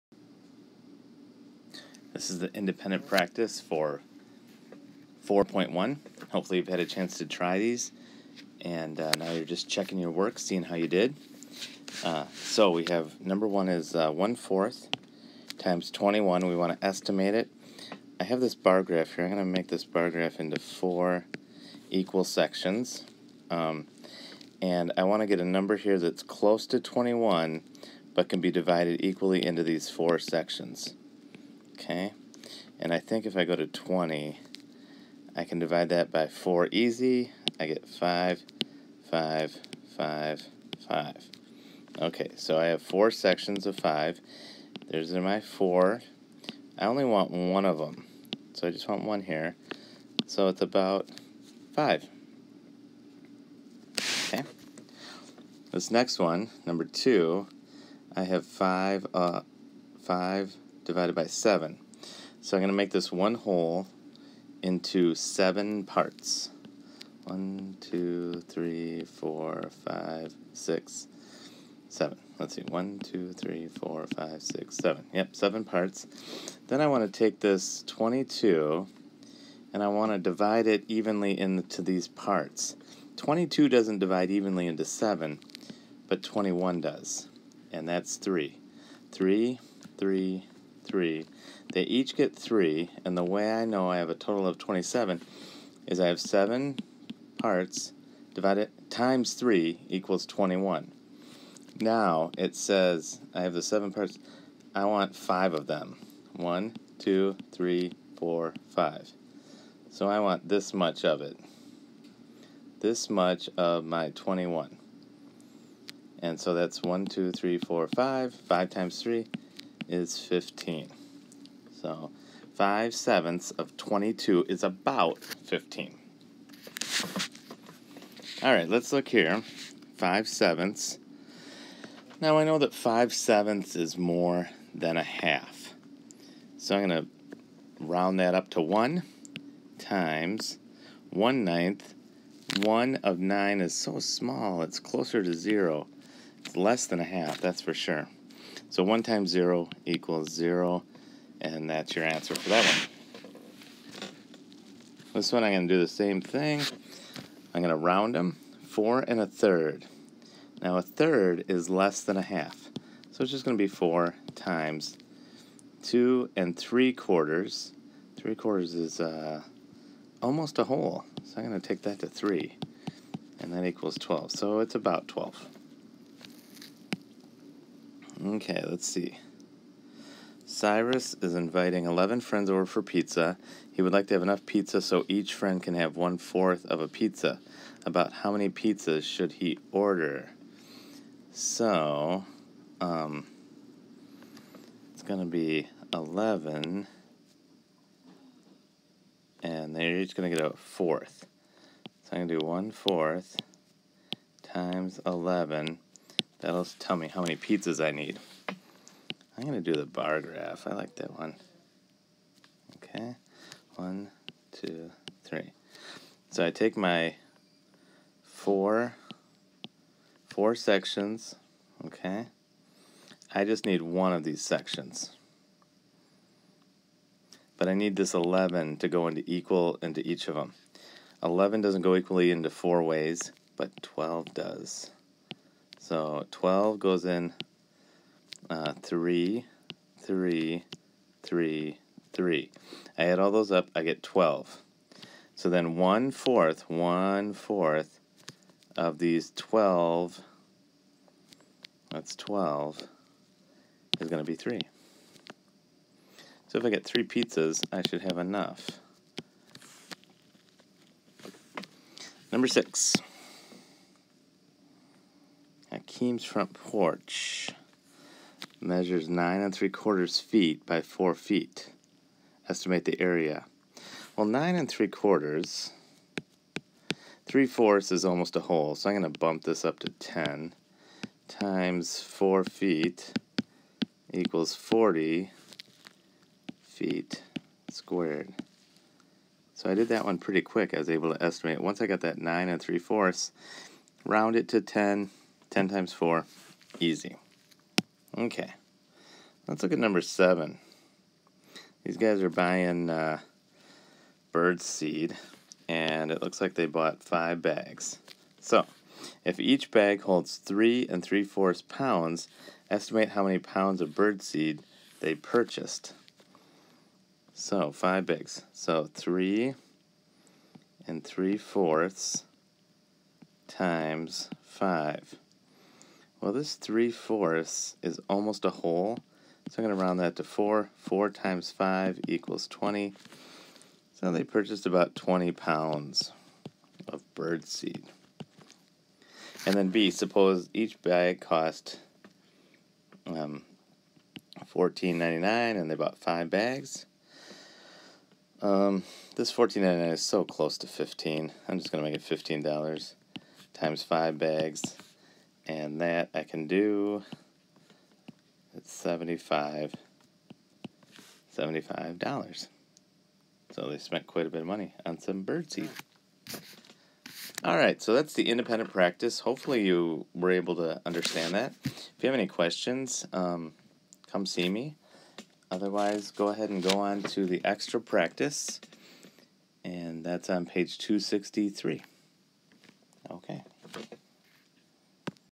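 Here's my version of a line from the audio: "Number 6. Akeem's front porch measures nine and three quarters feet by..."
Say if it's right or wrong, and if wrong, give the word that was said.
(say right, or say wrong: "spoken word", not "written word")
right.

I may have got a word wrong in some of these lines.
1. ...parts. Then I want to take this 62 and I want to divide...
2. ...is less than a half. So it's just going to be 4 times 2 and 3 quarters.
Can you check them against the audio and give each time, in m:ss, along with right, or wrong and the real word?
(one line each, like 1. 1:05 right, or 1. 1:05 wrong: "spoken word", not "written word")
1. 1:15 wrong: "22", not "62"
2. 2:41 right.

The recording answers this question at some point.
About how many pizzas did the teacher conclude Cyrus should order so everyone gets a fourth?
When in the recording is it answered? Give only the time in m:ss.
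4:16.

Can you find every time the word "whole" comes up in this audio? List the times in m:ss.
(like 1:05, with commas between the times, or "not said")
1:03, 2:50, 4:38, 5:28.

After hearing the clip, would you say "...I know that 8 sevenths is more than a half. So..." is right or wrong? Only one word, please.
wrong.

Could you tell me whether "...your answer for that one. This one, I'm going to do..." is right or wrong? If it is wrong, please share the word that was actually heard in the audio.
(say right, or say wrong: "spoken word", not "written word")
right.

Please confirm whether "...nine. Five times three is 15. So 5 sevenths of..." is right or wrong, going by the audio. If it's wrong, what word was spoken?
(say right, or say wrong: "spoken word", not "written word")
wrong: "five", not "nine".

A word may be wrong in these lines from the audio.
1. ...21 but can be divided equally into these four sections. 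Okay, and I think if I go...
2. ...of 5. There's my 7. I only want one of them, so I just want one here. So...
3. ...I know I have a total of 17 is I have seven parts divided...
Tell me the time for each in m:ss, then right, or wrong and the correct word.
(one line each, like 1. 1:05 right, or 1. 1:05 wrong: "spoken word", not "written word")
1. 0:26 right
2. 0:43 wrong: "4", not "7"
3. 1:33 wrong: "27", not "17".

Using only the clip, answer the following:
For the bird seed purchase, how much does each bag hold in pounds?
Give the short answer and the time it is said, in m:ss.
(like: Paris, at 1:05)
3 3/4 pounds, at 5:10.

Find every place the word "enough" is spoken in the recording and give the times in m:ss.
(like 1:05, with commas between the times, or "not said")
3:04, 4:18.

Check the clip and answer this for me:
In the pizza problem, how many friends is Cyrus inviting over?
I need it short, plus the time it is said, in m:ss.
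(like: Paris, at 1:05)
11, at 3:01.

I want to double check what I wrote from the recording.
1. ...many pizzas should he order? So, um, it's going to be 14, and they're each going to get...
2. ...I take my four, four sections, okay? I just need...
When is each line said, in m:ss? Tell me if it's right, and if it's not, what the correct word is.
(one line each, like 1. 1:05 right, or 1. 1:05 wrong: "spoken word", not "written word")
1. 3:08 wrong: "11", not "14"
2. 3:36 right.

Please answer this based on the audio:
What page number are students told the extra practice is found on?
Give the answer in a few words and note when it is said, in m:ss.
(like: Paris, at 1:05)
263, at 6:20.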